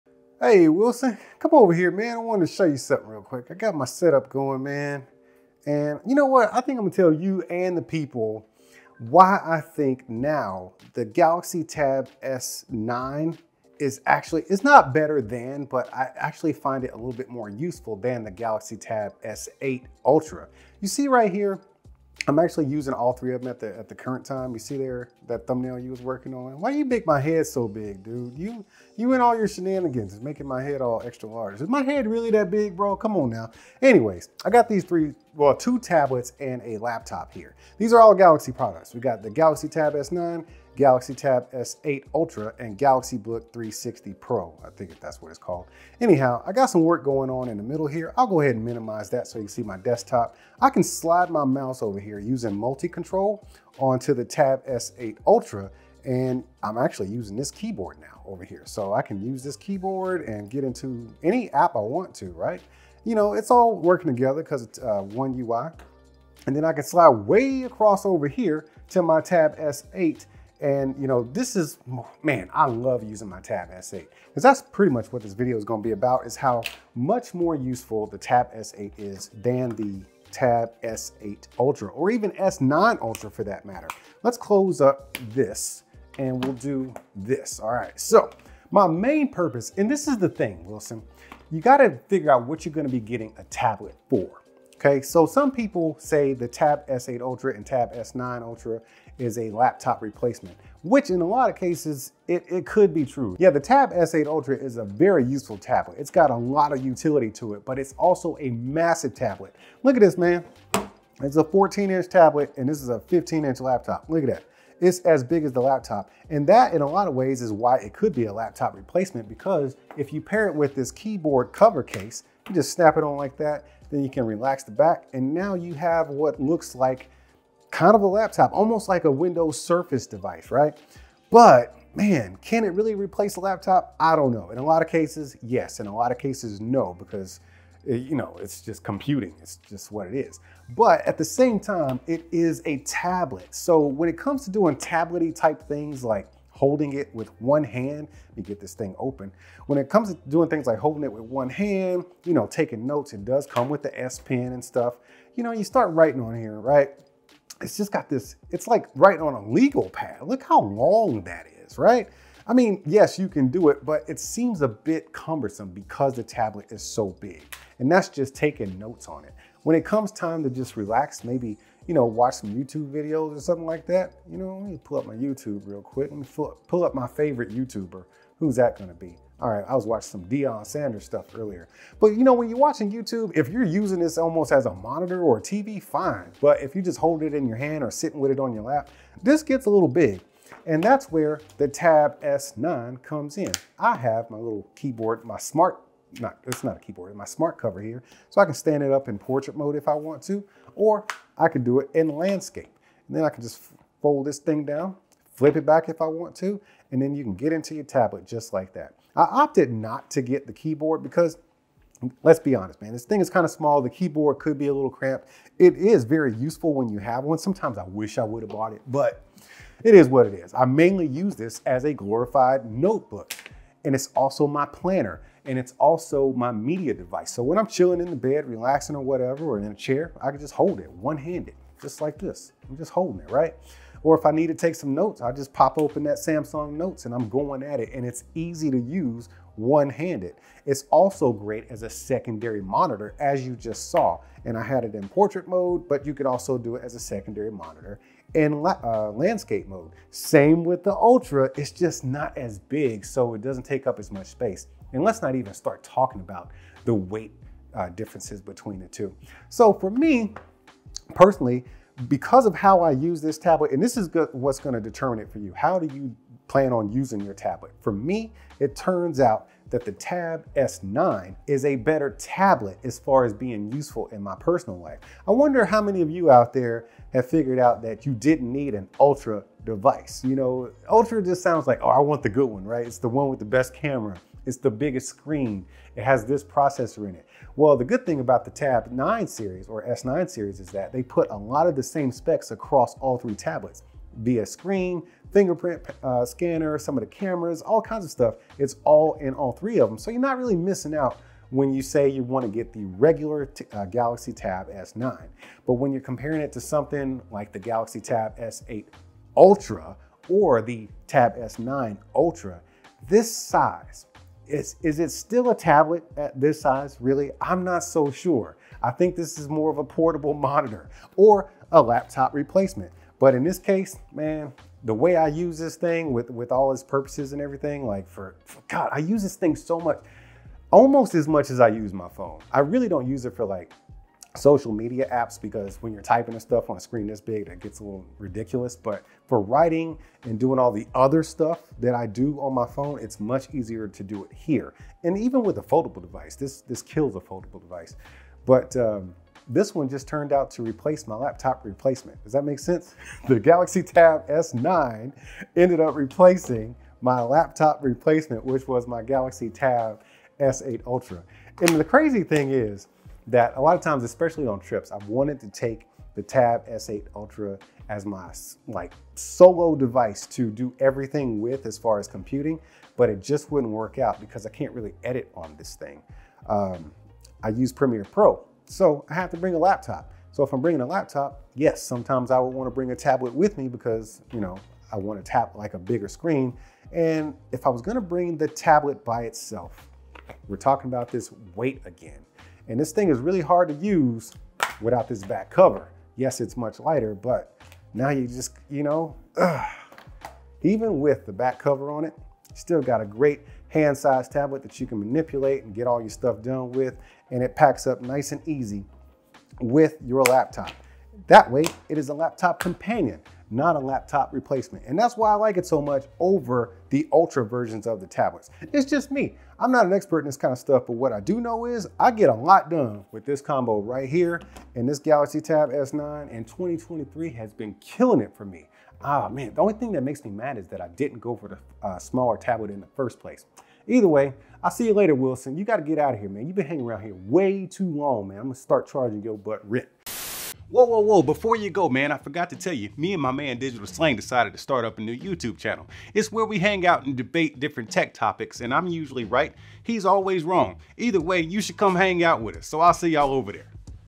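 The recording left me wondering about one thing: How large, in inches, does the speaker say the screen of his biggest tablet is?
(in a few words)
14 inch.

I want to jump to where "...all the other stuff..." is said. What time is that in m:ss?
5:40.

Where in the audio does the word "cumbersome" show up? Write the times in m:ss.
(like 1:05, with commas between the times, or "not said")
2:45.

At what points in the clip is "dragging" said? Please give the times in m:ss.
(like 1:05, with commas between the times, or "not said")
not said.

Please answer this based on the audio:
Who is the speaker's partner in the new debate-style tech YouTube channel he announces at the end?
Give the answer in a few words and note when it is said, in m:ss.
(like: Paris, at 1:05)
Digital Slang, at 7:23.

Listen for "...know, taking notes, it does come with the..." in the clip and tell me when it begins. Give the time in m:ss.
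2:32.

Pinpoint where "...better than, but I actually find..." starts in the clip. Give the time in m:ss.
0:14.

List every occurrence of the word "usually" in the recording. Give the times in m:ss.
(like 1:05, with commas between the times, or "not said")
7:28.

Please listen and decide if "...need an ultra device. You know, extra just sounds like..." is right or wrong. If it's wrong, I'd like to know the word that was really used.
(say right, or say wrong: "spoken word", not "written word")
wrong: "ultra", not "extra".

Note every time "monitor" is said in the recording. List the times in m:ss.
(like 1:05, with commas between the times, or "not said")
3:04, 4:02, 4:07, 5:20.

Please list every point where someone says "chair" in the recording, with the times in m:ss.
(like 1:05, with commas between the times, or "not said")
3:49.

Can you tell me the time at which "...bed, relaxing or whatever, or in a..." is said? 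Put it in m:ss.
3:48.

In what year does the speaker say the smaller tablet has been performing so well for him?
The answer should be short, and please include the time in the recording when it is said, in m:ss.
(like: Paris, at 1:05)
2023, at 7:06.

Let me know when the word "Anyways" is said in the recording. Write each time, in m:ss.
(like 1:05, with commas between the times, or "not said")
0:33.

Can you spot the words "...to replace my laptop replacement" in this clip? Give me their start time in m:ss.
5:50.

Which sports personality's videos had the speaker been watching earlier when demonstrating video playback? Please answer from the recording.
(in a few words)
Deion Sanders.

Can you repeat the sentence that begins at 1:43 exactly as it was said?
Yeah, the Tab S8 Ultra is a very useful tablet.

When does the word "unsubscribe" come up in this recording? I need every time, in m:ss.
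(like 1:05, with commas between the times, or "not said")
not said.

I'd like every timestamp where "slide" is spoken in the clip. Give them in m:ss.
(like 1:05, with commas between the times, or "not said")
0:50, 1:06.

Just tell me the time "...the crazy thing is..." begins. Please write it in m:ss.
6:01.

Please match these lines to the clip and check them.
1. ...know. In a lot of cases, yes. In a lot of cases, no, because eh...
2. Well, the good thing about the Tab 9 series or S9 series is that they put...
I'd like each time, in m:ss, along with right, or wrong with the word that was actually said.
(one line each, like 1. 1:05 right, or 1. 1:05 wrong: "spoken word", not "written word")
1. 2:14 right
2. 4:47 right.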